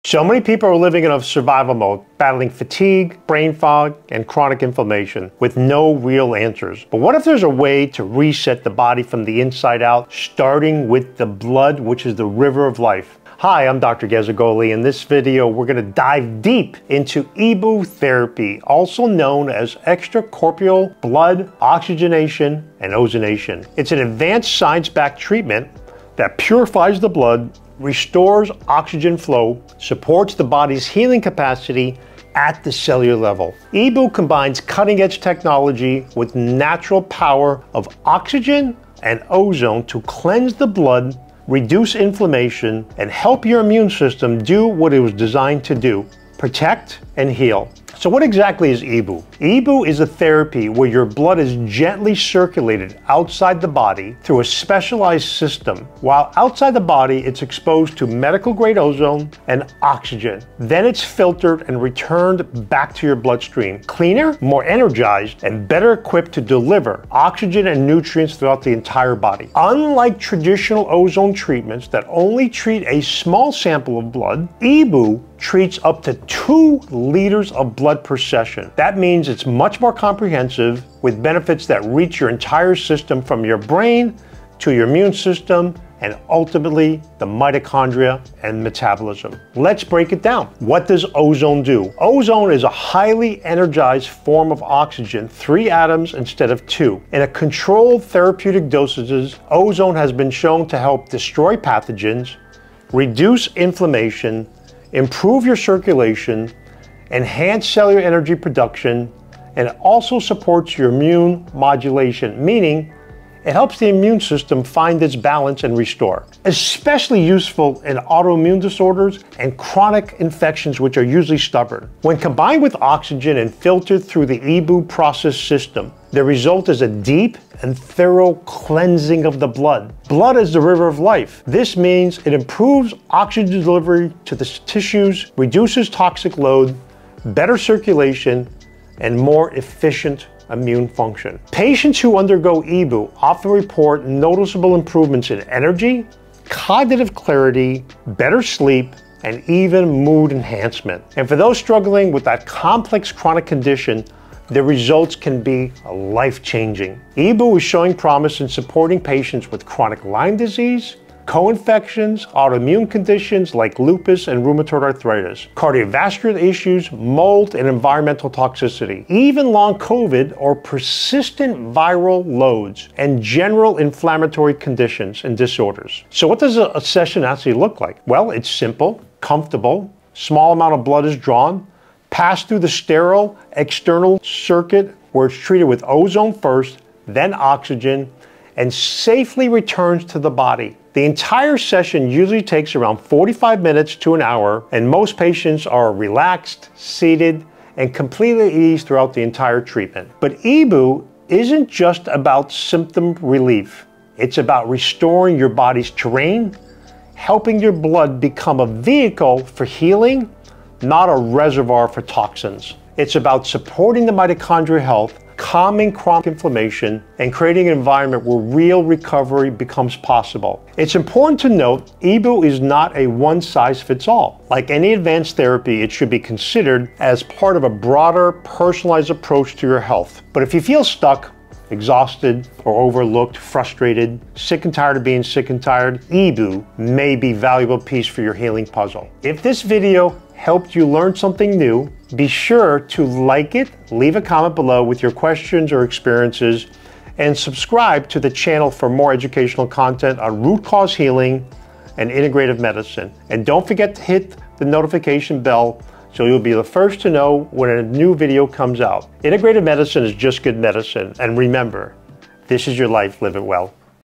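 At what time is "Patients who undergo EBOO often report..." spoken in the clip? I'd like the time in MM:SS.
02:21.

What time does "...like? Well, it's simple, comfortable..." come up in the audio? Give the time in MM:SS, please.
02:57.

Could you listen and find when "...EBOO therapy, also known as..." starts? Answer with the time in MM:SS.
00:17.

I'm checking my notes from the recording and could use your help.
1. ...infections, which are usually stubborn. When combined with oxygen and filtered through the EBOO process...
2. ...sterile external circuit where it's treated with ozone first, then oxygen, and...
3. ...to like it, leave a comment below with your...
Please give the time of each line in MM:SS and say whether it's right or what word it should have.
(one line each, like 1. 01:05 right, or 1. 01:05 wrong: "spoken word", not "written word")
1. 02:00 right
2. 03:02 right
3. 04:02 right.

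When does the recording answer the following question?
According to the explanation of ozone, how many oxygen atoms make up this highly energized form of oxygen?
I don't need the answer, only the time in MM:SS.
01:35.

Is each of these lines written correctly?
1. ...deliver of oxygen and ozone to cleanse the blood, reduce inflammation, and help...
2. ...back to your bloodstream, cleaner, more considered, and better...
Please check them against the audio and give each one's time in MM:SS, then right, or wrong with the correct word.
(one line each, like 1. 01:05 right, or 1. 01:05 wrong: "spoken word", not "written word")
1. 00:37 wrong: "power", not "deliver"
2. 01:02 wrong: "energized", not "considered".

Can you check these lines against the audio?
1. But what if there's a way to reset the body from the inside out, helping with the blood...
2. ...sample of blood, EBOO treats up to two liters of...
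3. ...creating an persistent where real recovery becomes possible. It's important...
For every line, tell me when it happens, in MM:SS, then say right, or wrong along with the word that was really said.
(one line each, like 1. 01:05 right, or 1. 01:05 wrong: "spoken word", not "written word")
1. 00:06 wrong: "starting", not "helping"
2. 01:13 right
3. 03:37 wrong: "environment", not "persistent".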